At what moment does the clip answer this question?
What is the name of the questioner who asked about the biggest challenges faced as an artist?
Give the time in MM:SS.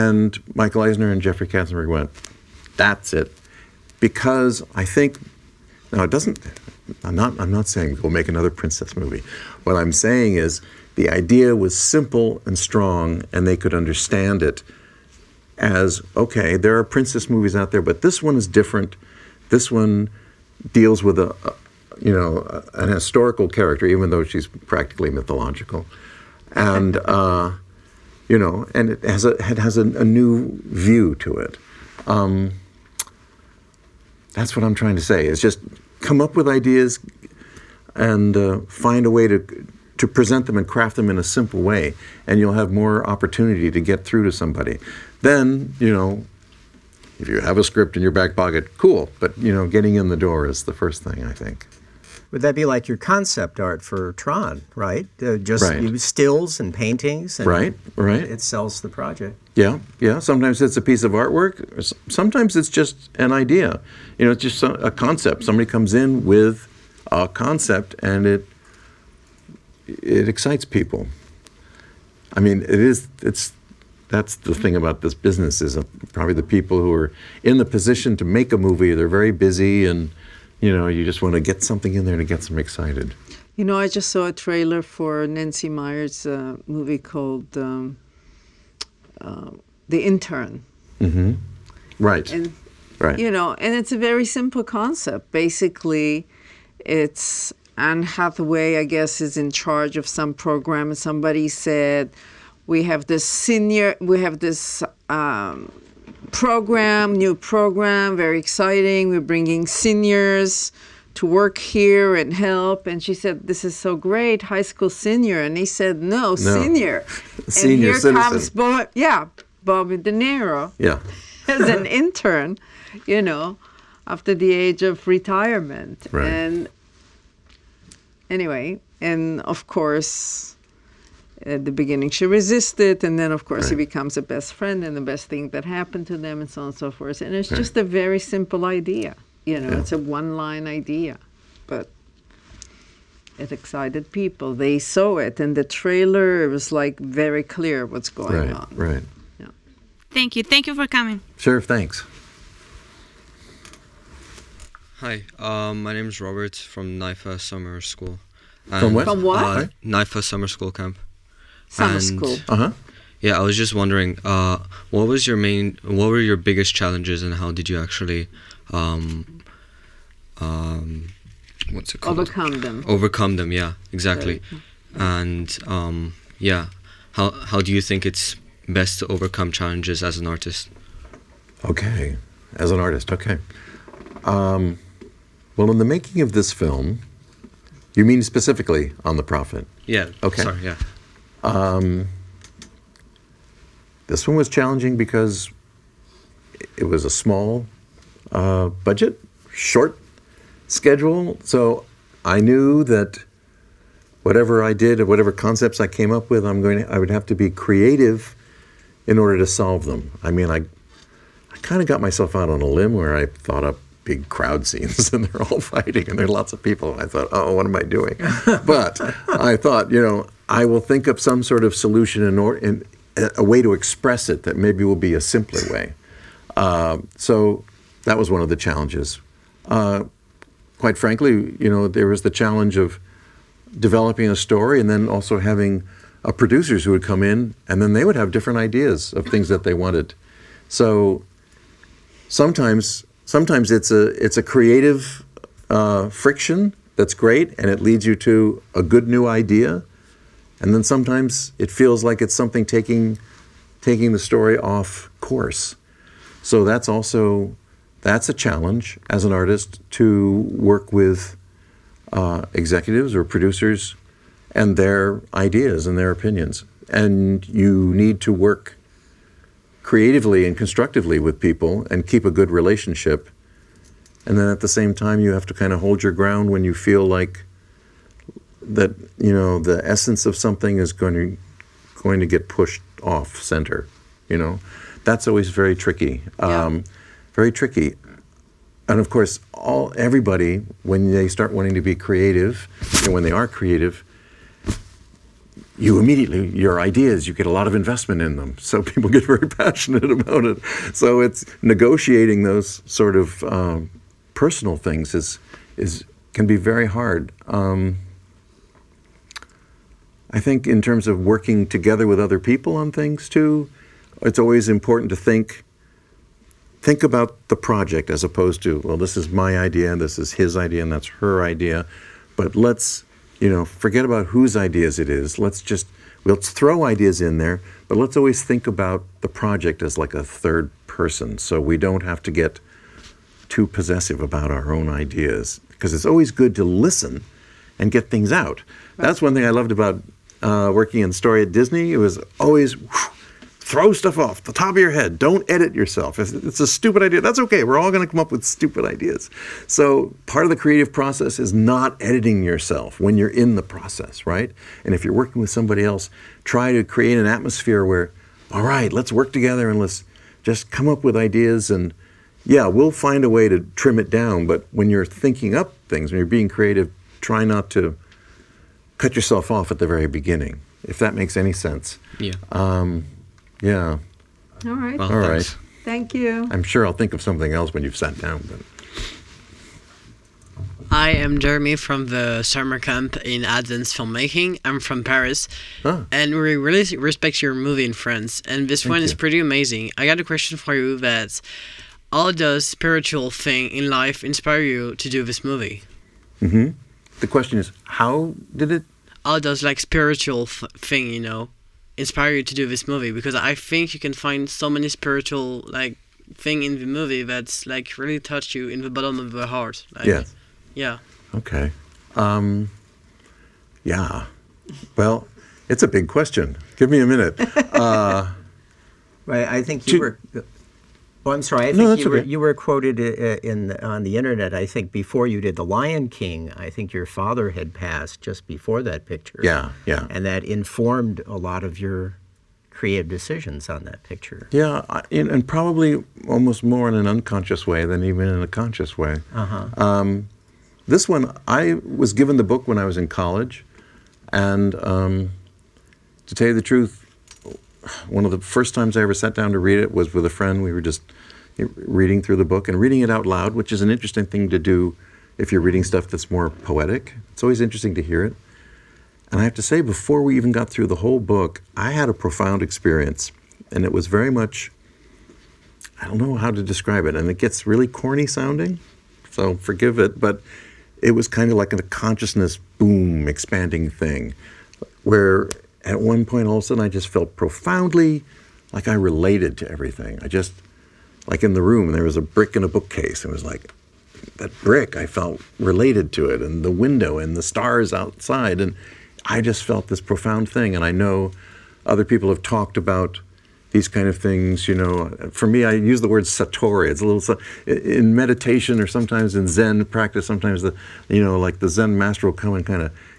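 02:36.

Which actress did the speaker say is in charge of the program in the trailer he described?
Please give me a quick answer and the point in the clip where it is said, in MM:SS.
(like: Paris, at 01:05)
Anne Hathaway, at 01:37.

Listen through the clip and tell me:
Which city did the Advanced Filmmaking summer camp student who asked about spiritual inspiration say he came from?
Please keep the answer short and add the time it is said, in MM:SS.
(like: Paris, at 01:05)
Paris, at 06:25.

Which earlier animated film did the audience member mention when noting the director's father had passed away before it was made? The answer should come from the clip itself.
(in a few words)
The Lion King.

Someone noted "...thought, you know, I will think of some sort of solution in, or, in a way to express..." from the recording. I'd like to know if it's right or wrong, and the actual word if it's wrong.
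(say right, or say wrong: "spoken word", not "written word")
right.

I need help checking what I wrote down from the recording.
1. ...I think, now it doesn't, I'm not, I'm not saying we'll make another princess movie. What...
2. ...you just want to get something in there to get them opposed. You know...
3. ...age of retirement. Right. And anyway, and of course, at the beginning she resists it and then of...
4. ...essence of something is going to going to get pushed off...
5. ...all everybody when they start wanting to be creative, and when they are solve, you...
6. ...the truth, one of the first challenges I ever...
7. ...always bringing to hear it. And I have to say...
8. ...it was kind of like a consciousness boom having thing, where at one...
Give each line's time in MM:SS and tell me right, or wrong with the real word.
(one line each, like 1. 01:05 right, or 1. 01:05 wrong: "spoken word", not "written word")
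1. 00:04 right
2. 01:20 wrong: "excited", not "opposed"
3. 02:04 right
4. 04:39 right
5. 04:49 wrong: "creative", not "solve"
6. 07:26 wrong: "times", not "challenges"
7. 07:37 wrong: "interesting", not "bringing"
8. 07:51 wrong: "expanding", not "having".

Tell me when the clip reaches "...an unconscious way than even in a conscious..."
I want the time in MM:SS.
07:16.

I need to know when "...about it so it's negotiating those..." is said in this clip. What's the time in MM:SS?
05:00.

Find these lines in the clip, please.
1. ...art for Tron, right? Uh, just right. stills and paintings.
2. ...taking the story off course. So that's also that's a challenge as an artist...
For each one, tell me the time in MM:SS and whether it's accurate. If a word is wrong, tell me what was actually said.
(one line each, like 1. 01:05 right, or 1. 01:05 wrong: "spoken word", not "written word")
1. 00:53 right
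2. 04:13 right.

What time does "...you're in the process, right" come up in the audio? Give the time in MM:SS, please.
05:53.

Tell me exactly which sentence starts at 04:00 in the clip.
So sometimes, sometimes it's a it's a creative uh, friction that's great and it leads you to a good new idea.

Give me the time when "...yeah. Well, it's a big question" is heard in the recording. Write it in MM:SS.
06:53.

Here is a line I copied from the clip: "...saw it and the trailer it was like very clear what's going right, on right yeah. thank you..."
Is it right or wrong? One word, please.
right.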